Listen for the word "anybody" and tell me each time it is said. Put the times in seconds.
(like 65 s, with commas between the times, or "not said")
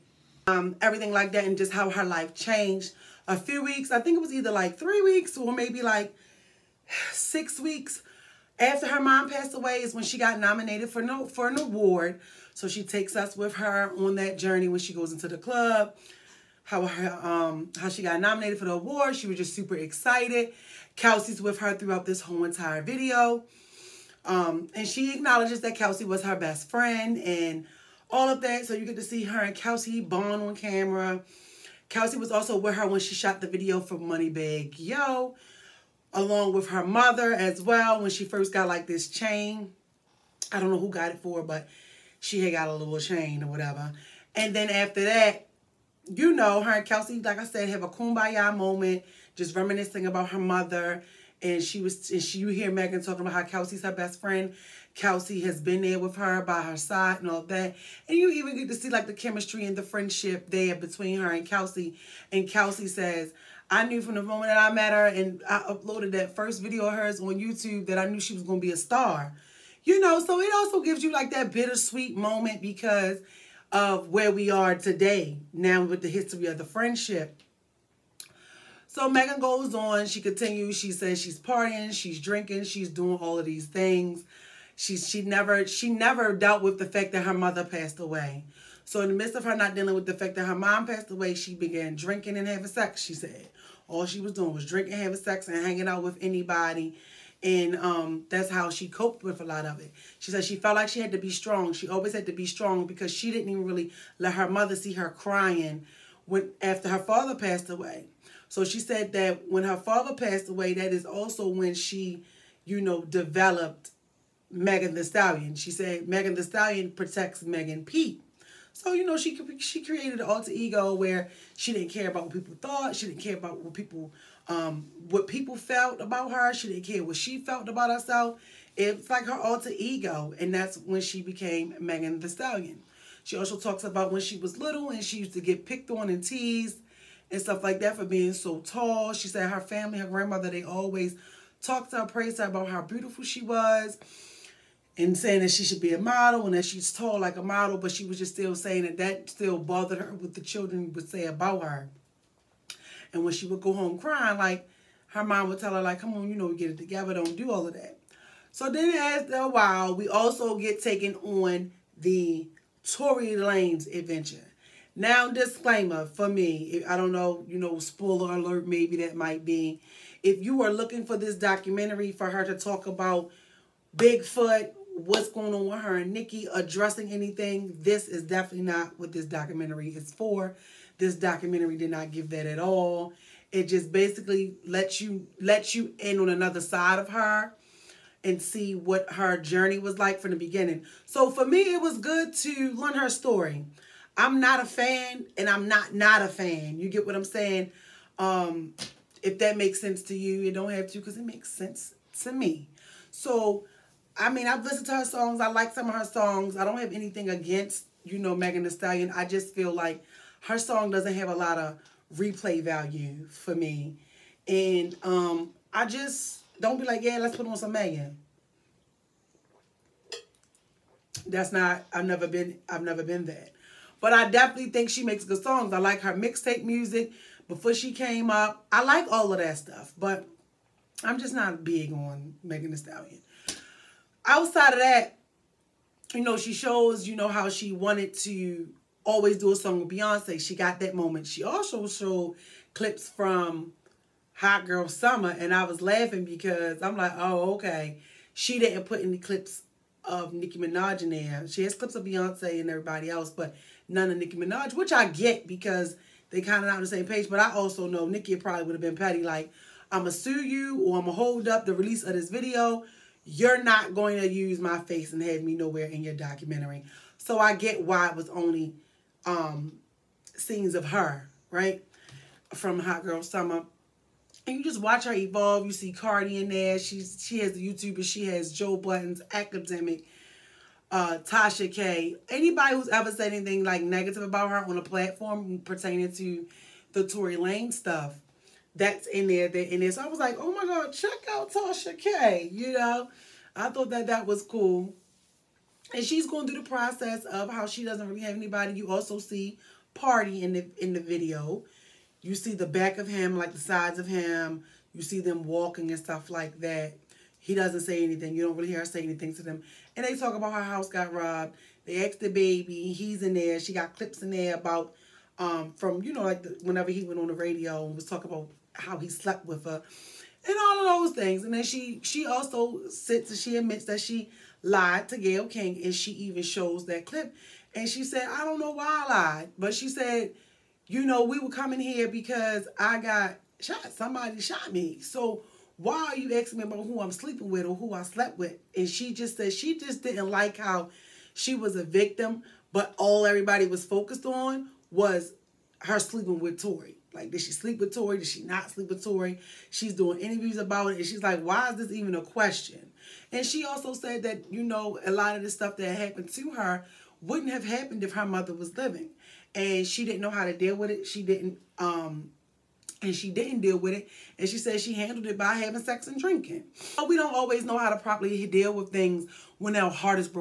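96 s, 282 s, 298 s.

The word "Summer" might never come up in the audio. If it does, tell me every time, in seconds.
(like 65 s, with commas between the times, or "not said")
244 s, 273 s.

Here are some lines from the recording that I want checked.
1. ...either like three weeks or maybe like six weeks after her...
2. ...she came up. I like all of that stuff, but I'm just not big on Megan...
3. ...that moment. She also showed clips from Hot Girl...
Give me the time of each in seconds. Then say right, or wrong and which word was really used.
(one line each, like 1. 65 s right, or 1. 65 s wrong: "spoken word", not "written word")
1. 4 s right
2. 227 s right
3. 240 s right.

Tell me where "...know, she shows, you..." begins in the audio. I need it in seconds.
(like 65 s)
236 s.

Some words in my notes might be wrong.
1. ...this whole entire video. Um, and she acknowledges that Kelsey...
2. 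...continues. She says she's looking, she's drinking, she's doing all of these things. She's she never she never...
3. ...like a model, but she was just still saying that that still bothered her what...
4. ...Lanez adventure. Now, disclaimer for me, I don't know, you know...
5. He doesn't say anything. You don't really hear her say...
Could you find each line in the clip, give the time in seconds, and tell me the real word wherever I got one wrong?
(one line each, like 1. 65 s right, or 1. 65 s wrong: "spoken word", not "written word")
1. 22 s right
2. 80 s wrong: "partying", not "looking"
3. 147 s right
4. 163 s right
5. 307 s right.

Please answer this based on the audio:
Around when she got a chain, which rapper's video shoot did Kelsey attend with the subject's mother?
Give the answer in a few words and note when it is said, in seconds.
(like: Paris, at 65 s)
Moneybagg Yo, at 33 s.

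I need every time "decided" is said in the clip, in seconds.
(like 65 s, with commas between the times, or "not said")
not said.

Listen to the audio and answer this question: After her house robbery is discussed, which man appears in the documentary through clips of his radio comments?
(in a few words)
DaBaby.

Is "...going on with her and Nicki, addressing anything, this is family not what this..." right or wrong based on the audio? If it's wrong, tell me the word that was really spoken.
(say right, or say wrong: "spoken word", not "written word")
wrong: "definitely", not "family".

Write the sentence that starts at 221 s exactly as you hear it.
That's not, I've never been, I've never been that.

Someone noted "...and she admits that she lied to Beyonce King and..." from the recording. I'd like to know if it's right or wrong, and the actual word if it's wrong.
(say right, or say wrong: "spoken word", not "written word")
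wrong: "Gayle", not "Beyonce".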